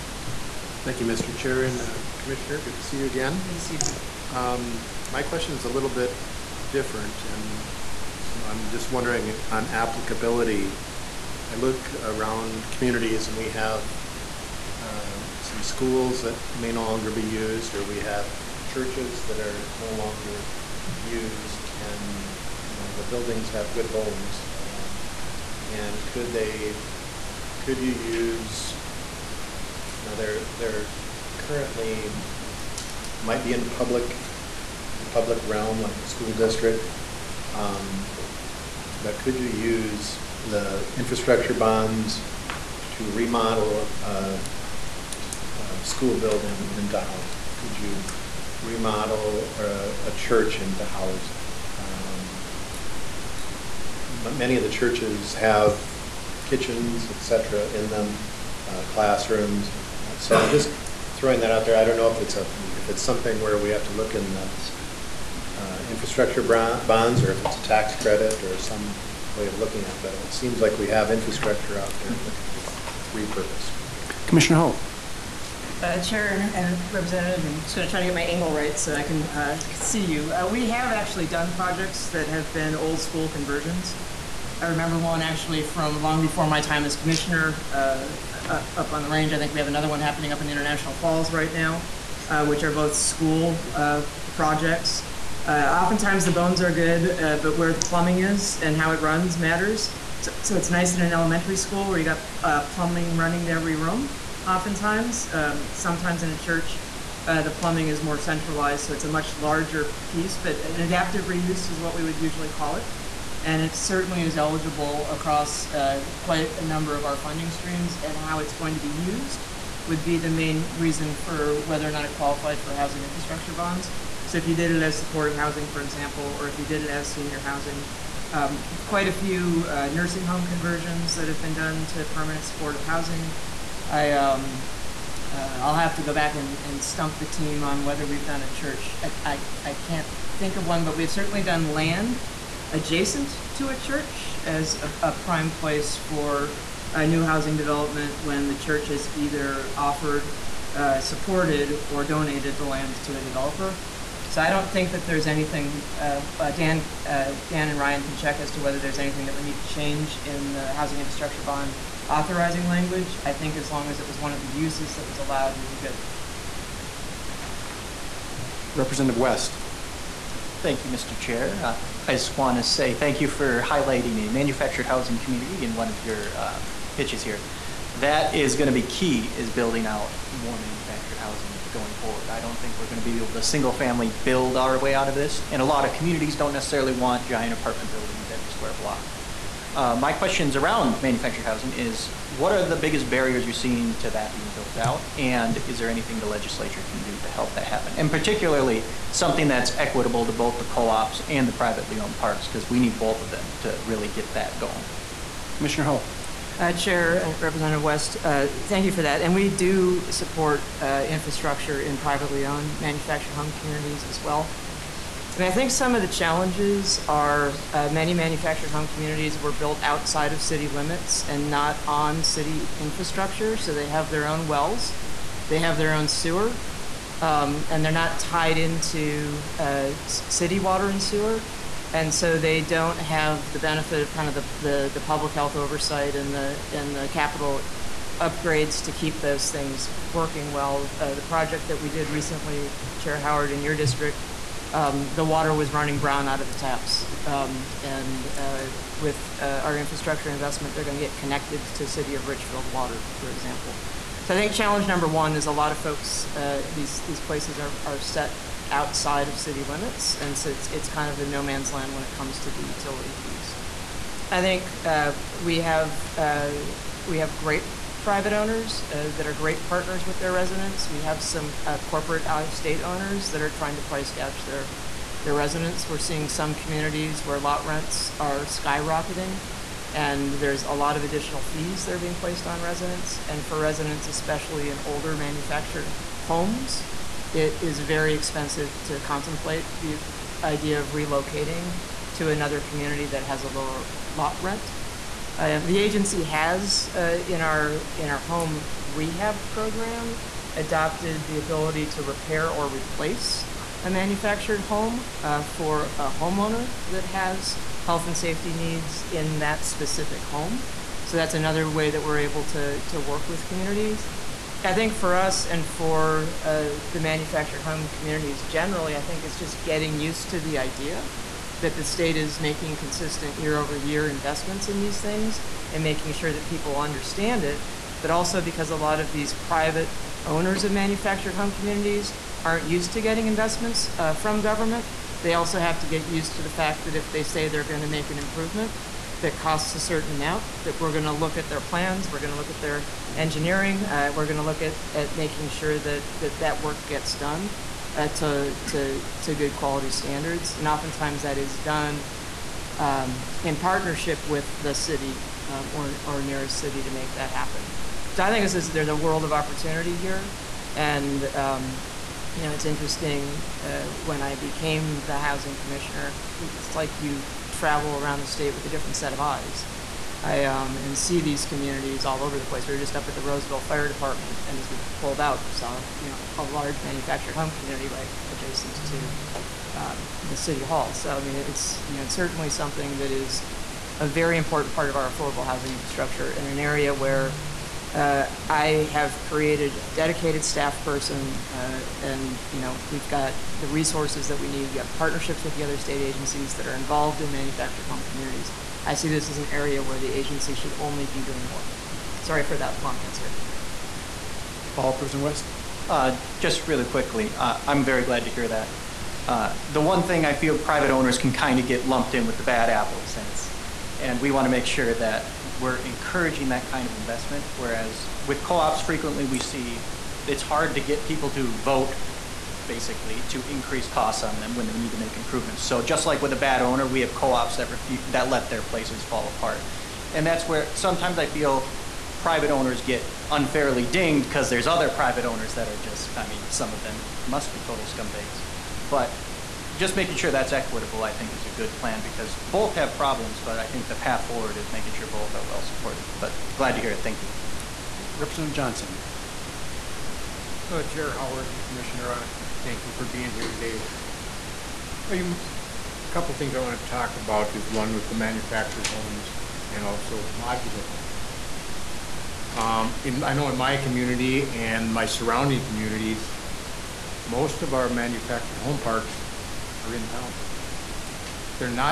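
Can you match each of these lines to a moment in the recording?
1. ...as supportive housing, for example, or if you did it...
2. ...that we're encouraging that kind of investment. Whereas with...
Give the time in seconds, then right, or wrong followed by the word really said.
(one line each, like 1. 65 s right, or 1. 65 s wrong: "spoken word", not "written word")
1. 124 s right
2. 414 s right.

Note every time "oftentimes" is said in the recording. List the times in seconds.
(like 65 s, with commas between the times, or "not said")
95 s, 104 s, 350 s.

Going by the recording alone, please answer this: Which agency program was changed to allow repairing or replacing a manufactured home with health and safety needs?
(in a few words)
home rehab program.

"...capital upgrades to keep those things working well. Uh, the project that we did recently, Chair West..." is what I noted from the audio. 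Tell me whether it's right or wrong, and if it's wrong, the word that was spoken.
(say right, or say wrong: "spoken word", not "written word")
wrong: "Howard", not "West".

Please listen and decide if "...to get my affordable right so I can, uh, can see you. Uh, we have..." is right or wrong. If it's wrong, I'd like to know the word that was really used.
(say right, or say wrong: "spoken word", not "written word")
wrong: "angle", not "affordable".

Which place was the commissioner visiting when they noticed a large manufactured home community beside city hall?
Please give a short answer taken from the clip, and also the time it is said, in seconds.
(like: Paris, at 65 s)
Roseville Fire Department, at 373 s.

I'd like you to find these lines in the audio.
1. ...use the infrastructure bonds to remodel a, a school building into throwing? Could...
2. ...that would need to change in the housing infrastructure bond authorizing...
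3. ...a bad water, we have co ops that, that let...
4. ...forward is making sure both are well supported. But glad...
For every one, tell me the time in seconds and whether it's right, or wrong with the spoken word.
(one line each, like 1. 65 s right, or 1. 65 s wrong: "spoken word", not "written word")
1. 39 s wrong: "housing", not "throwing"
2. 159 s right
3. 426 s wrong: "owner", not "water"
4. 444 s right.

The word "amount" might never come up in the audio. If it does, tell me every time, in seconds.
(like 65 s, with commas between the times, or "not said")
340 s.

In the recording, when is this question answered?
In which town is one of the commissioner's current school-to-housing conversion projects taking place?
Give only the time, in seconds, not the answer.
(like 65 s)
90 s.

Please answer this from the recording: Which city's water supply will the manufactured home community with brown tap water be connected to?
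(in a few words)
Richfield.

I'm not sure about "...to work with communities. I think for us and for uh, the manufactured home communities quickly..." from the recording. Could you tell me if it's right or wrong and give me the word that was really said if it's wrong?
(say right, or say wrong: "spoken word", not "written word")
wrong: "generally", not "quickly".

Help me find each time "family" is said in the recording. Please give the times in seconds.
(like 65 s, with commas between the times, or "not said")
183 s.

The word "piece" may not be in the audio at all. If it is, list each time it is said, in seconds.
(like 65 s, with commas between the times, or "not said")
110 s, 263 s.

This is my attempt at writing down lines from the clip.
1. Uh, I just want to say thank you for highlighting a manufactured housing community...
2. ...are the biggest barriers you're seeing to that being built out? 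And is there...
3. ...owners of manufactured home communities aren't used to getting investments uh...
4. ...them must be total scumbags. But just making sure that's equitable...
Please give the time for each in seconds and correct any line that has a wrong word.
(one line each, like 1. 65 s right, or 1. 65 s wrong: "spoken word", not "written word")
1. 171 s right
2. 192 s right
3. 330 s right
4. 436 s right.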